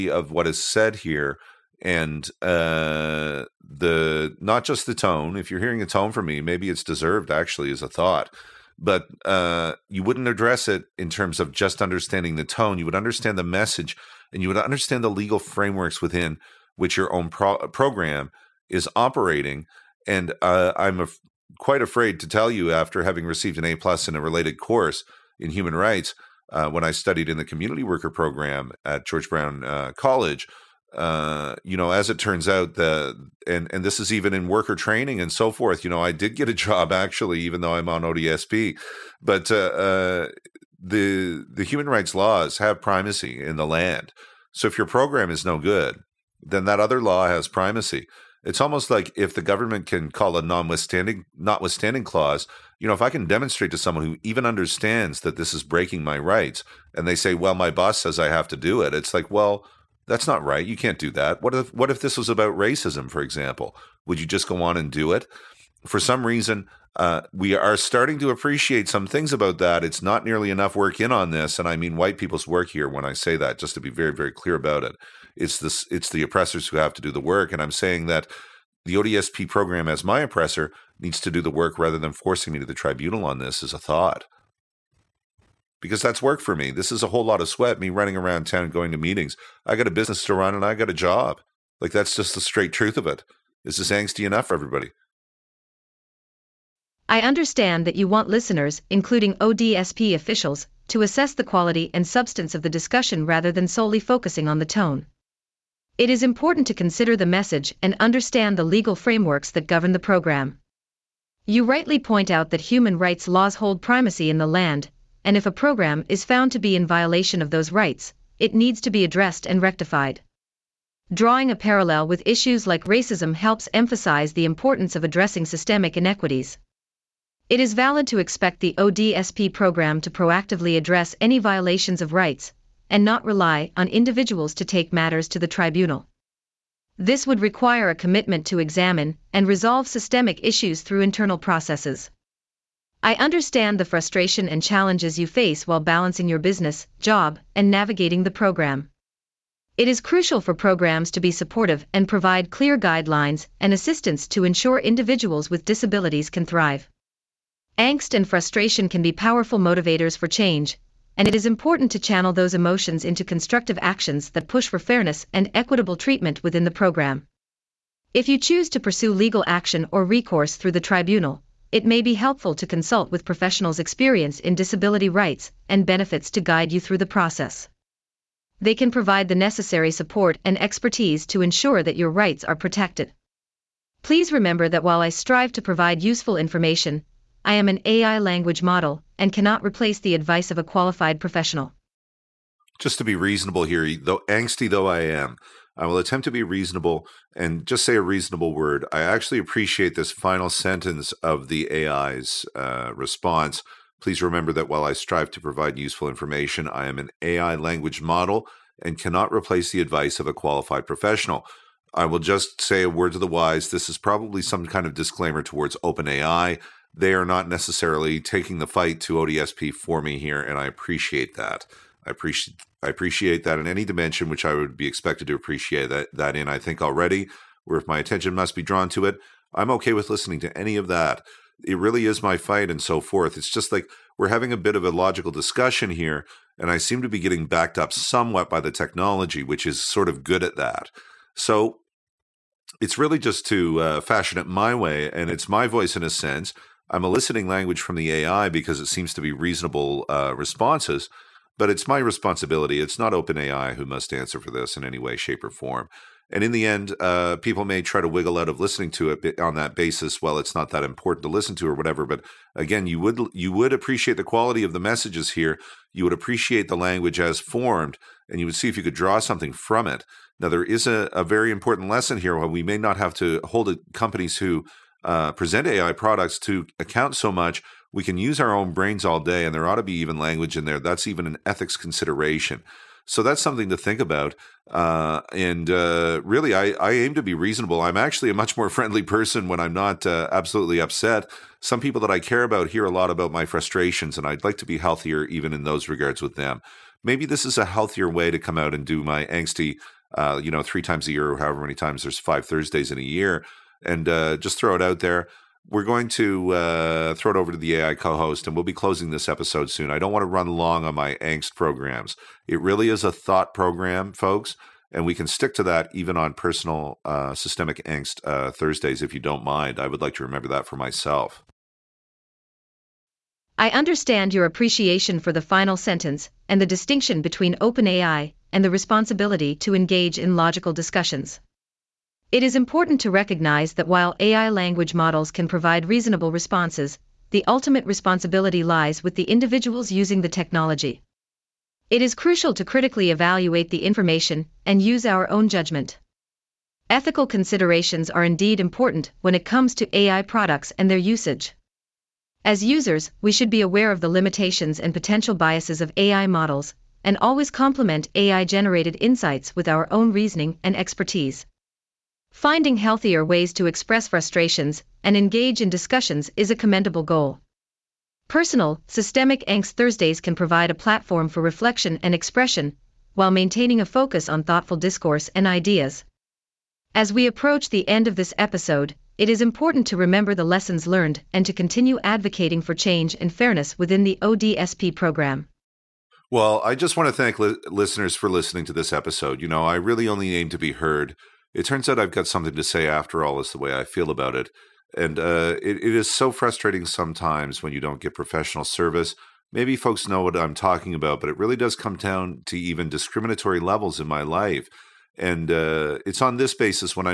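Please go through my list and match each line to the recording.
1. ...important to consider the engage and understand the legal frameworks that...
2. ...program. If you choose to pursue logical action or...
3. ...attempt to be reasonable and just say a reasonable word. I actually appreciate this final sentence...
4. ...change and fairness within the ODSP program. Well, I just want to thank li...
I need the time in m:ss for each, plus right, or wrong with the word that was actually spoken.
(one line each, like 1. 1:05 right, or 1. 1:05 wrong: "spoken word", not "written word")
1. 1:46 wrong: "message", not "engage"
2. 2:46 wrong: "legal", not "logical"
3. 3:15 right
4. 6:22 right.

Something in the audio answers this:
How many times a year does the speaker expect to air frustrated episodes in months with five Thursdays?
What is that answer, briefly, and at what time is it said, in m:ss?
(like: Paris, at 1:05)
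3, at 5:00.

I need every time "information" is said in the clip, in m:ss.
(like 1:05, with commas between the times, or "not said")
3:06, 3:26, 5:43.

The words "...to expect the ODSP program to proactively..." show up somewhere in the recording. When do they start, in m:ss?
2:08.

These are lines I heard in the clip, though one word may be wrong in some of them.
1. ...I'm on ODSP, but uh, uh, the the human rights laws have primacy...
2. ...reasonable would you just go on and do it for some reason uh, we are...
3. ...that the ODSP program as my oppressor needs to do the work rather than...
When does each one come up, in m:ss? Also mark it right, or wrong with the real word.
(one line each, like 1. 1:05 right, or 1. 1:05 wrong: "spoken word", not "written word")
1. 0:37 right
2. 1:03 wrong: "example", not "reasonable"
3. 1:18 right.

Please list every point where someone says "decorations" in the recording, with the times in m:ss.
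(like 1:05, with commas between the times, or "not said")
not said.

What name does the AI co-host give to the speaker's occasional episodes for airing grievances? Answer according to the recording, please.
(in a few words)
Personal, Systemic Angst Thursdays.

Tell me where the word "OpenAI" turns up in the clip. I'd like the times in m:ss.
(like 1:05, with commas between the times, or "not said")
3:35, 4:13, 5:27.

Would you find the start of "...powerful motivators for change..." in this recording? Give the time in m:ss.
2:39.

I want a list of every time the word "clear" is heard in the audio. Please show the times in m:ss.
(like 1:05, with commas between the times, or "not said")
1:14, 2:32.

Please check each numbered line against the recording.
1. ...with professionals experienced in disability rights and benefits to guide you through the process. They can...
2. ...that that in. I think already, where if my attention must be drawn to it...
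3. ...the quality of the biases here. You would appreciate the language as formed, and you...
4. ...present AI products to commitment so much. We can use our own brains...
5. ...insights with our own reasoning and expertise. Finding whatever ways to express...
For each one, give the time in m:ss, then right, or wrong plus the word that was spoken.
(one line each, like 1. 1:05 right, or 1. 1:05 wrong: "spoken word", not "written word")
1. 2:53 right
2. 3:45 right
3. 4:24 wrong: "messages", not "biases"
4. 4:35 wrong: "account", not "commitment"
5. 5:59 wrong: "healthier", not "whatever".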